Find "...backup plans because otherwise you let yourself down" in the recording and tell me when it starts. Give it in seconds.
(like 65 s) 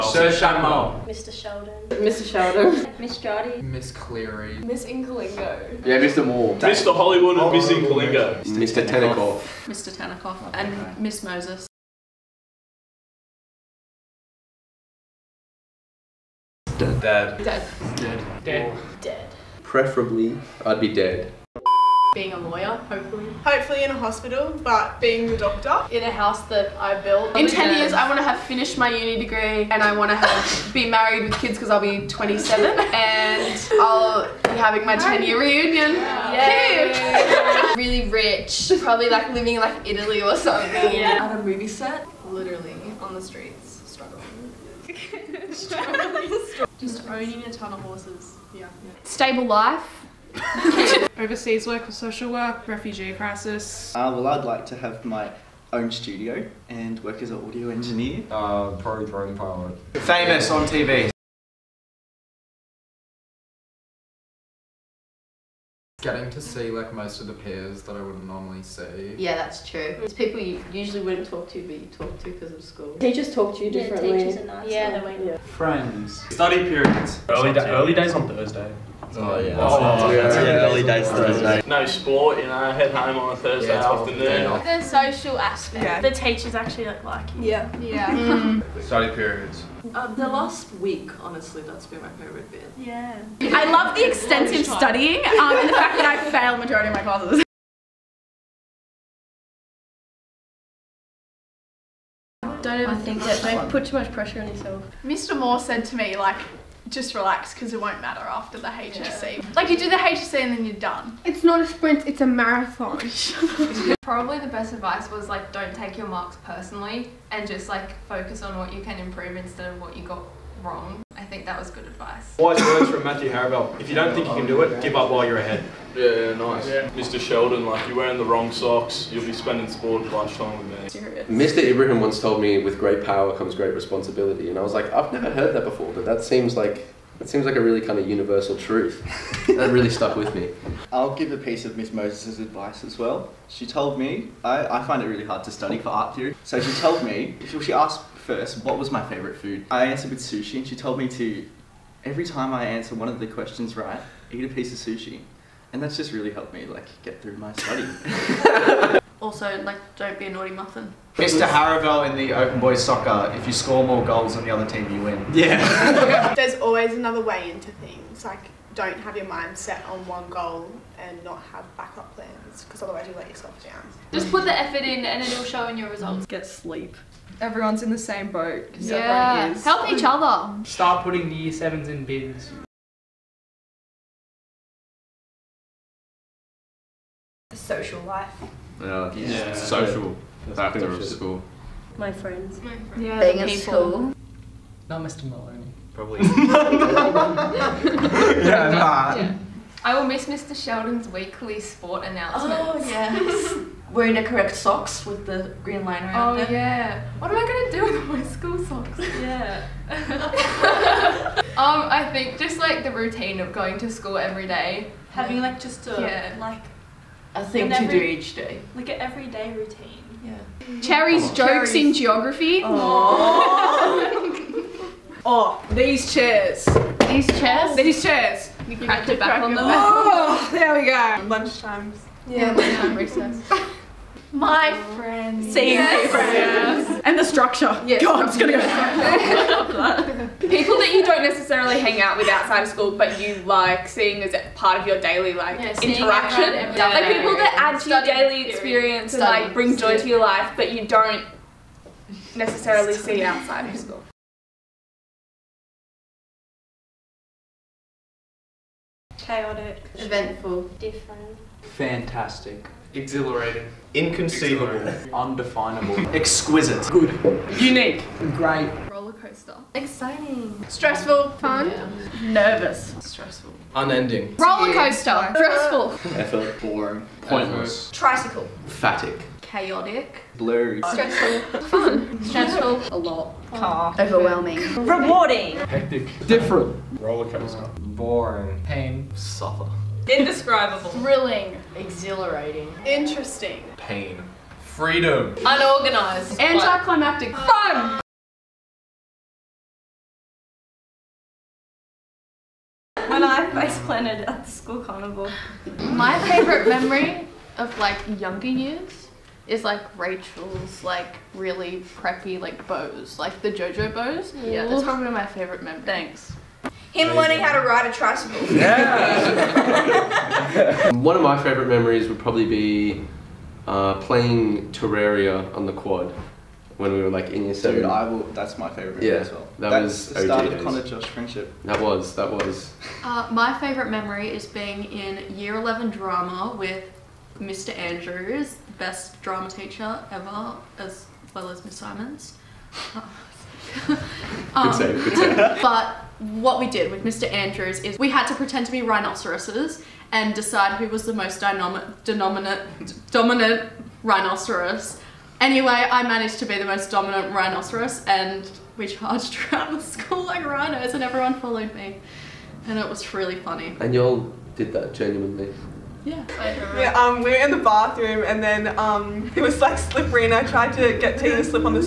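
171 s.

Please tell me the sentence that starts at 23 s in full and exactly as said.
Hopefully in a hospital, but being the doctor.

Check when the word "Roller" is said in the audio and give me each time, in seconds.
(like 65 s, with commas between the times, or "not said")
268 s, 274 s, 287 s.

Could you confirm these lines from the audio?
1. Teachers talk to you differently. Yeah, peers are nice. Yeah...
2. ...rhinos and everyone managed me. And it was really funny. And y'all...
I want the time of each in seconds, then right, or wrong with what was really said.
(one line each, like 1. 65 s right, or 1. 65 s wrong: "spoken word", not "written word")
1. 73 s wrong: "teachers", not "peers"
2. 360 s wrong: "followed", not "managed".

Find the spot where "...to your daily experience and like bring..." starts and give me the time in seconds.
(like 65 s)
247 s.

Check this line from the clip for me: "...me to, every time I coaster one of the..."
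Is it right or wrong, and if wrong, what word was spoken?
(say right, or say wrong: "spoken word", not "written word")
wrong: "answer", not "coaster".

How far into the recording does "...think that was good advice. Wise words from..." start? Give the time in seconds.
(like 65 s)
121 s.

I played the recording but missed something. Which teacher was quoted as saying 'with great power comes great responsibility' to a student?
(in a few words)
Mr. Ibrahim.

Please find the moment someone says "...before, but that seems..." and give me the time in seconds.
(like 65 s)
135 s.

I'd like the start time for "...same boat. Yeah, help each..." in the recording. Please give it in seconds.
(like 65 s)
177 s.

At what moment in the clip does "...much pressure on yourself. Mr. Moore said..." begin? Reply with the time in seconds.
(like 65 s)
103 s.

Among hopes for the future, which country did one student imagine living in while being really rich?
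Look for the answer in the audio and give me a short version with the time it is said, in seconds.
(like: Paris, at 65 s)
Italy, at 39 s.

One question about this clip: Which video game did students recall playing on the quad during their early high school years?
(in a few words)
Terraria.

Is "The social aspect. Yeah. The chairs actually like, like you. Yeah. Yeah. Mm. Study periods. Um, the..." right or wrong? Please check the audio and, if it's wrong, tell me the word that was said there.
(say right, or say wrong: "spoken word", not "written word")
wrong: "teachers", not "chairs".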